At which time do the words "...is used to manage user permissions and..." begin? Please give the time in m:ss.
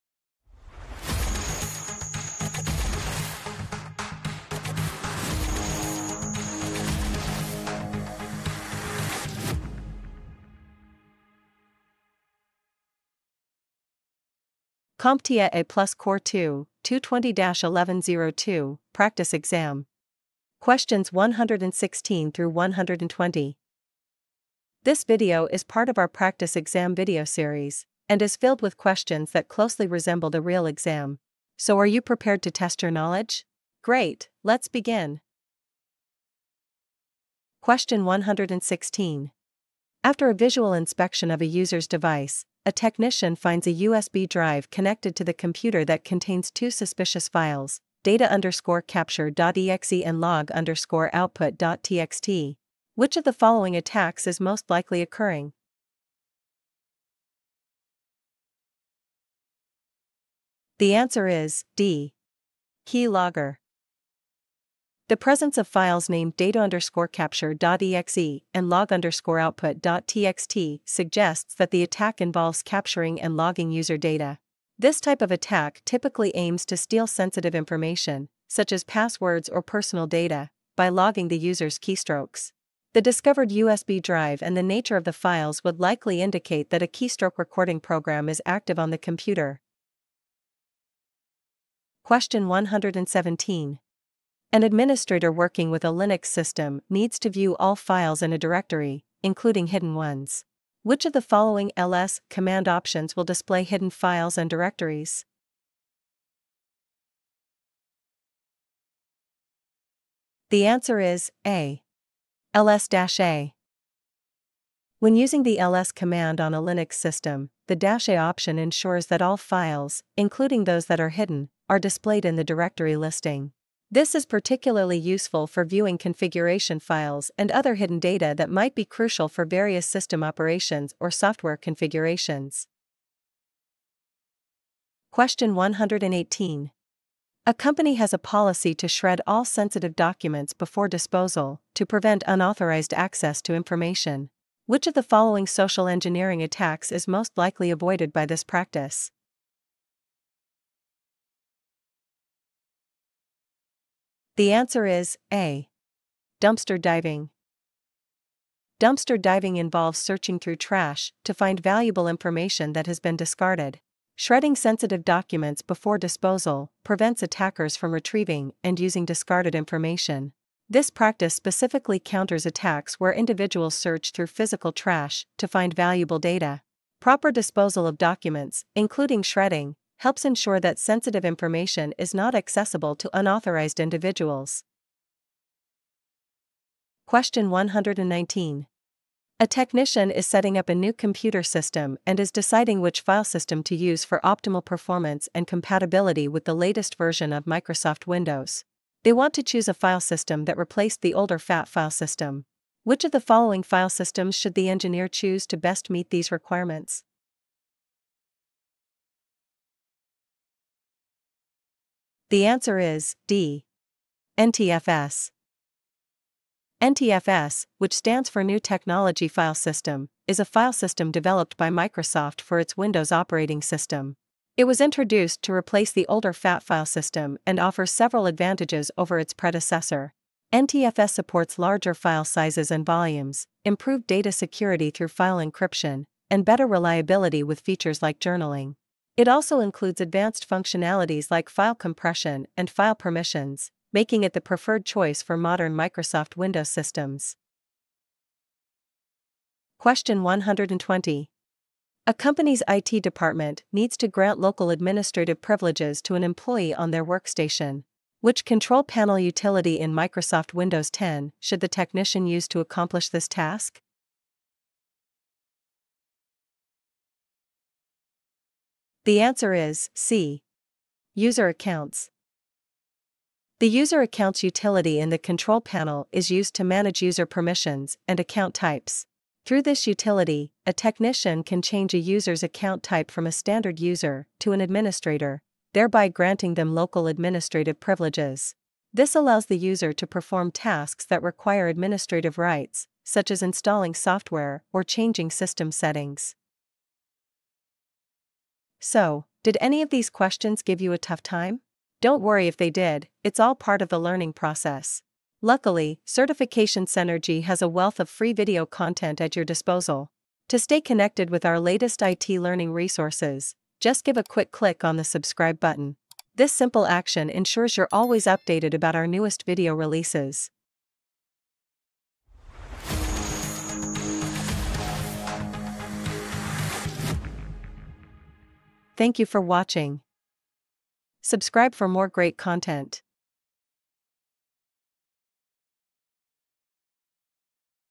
4:36.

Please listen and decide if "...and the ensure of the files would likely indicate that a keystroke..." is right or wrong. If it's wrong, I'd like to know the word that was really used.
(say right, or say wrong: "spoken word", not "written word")
wrong: "nature", not "ensure".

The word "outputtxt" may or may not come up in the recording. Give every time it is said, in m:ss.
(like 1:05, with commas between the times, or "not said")
0:51, 1:09.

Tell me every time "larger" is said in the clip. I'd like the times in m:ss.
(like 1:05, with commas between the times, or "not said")
3:51.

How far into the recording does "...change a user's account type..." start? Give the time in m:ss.
4:41.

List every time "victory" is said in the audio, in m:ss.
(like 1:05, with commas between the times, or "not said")
not said.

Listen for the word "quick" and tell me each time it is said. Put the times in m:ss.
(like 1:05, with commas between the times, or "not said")
5:14.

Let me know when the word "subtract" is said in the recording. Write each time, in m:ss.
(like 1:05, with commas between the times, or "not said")
not said.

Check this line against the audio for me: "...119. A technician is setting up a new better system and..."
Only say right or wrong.
wrong.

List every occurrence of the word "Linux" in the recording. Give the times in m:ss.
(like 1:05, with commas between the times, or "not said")
1:35, 1:56.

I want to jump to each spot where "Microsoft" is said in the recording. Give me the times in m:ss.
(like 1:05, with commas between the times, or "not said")
3:17, 3:41, 4:05, 4:19.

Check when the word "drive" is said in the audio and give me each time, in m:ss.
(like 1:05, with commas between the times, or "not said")
0:44, 1:24.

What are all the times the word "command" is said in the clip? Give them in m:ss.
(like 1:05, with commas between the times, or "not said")
1:42, 1:55.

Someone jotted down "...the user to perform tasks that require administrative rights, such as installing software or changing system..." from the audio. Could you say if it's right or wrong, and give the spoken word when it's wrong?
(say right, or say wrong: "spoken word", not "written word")
right.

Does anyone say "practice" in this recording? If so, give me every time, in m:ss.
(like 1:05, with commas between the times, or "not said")
0:18, 0:26, 2:28, 2:50.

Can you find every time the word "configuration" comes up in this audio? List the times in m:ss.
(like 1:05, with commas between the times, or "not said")
2:05, 2:11.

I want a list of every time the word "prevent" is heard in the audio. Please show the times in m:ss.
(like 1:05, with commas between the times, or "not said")
2:21, 2:46.